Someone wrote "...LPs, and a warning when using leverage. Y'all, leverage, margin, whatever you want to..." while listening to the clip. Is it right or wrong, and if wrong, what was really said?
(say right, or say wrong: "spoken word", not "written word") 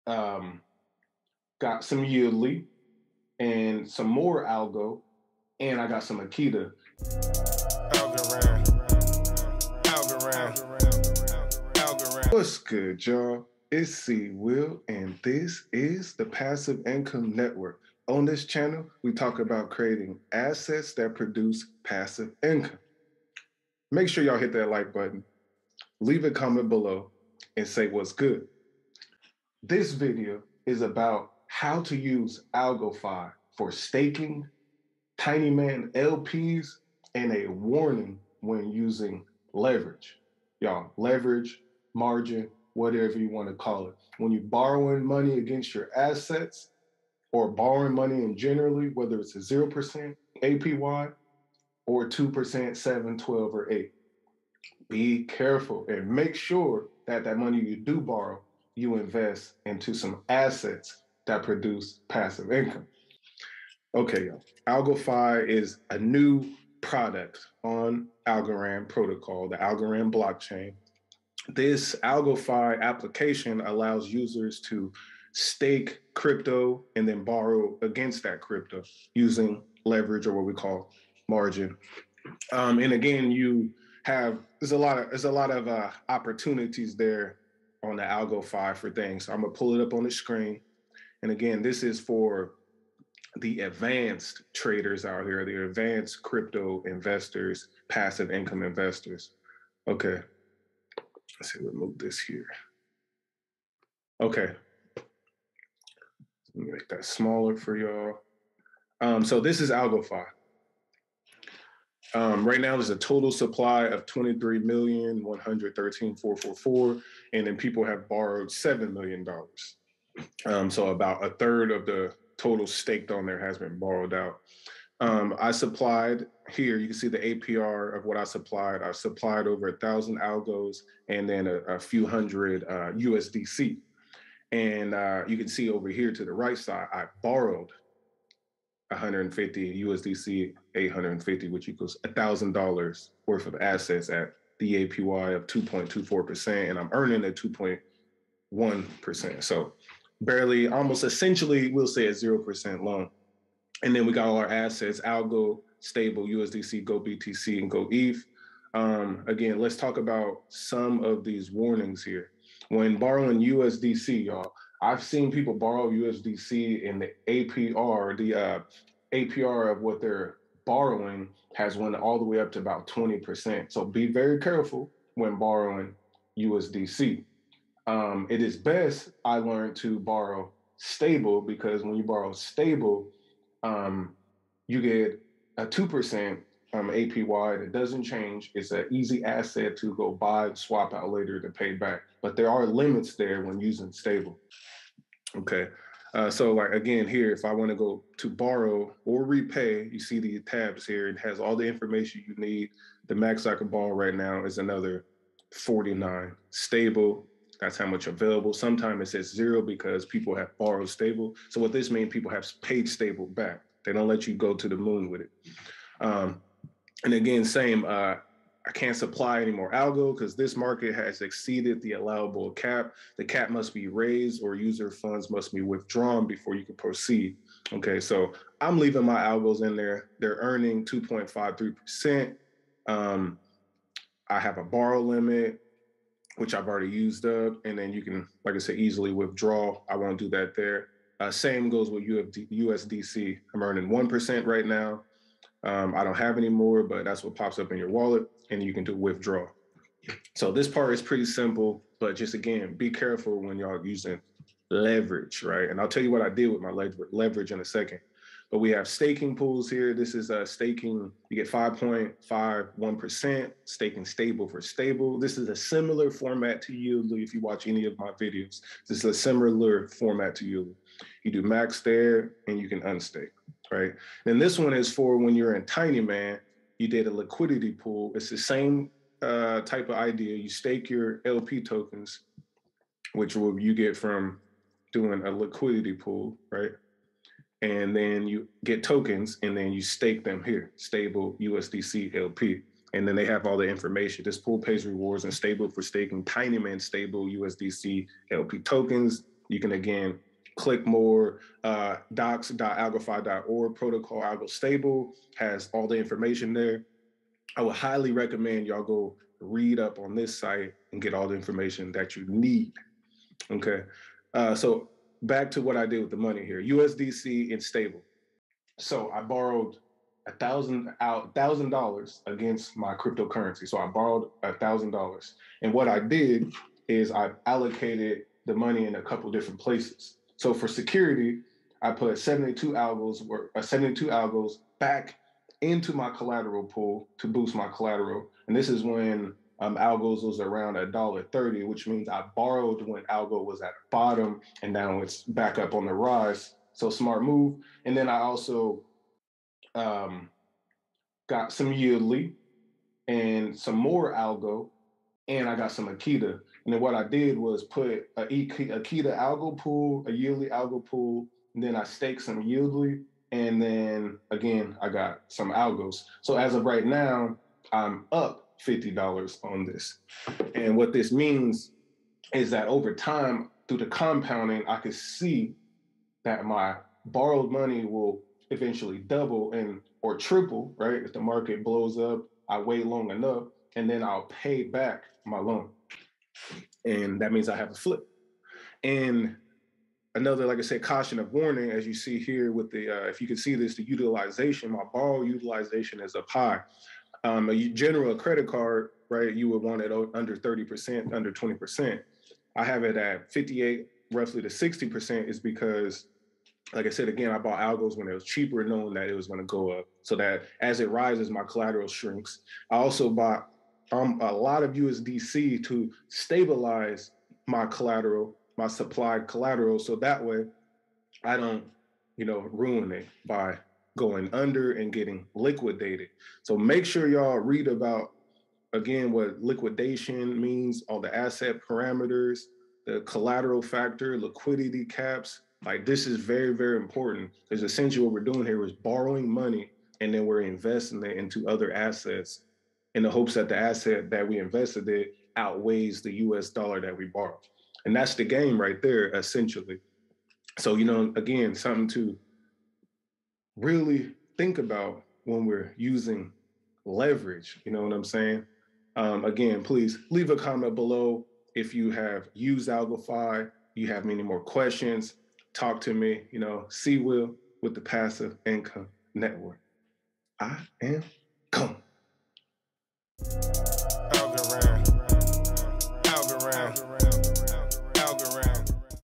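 right.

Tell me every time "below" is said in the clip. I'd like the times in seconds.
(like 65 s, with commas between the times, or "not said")
26 s, 460 s.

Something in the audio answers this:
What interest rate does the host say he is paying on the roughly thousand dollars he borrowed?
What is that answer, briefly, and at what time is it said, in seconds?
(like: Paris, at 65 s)
2.24%, at 145 s.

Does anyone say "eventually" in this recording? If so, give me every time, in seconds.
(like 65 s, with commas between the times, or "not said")
378 s.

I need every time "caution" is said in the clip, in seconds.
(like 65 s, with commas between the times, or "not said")
390 s.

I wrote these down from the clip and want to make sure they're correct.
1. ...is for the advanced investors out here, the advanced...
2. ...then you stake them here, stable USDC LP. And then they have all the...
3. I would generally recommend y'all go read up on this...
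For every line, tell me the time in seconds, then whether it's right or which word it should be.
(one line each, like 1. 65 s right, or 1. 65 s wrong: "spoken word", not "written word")
1. 91 s wrong: "traders", not "investors"
2. 289 s right
3. 307 s wrong: "highly", not "generally".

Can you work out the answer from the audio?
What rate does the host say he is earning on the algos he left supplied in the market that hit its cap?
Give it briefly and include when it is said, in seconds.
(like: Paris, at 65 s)
2.53%, at 230 s.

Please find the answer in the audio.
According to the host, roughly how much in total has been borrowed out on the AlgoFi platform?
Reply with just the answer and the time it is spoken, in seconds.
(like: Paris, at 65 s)
$7 million, at 118 s.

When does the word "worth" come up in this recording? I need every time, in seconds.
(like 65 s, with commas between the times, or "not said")
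143 s.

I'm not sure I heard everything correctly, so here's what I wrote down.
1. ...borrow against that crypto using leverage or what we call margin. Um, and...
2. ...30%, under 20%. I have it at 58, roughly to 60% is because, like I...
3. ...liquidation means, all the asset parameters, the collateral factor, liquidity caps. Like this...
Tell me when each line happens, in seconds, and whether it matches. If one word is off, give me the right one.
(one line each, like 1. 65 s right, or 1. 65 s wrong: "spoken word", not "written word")
1. 77 s right
2. 400 s right
3. 429 s right.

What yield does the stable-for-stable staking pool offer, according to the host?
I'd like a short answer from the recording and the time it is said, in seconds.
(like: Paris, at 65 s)
5.51%, at 261 s.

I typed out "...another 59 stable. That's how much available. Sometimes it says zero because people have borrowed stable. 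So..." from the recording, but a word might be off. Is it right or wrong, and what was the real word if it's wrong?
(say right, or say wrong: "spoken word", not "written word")
wrong: "49", not "59".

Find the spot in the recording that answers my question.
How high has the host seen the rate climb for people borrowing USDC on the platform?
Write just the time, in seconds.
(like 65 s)
172 s.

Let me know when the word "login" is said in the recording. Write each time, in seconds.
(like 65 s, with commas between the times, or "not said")
not said.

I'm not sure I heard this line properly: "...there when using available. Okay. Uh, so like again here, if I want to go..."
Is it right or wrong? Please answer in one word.
wrong.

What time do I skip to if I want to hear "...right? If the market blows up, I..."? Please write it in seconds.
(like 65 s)
380 s.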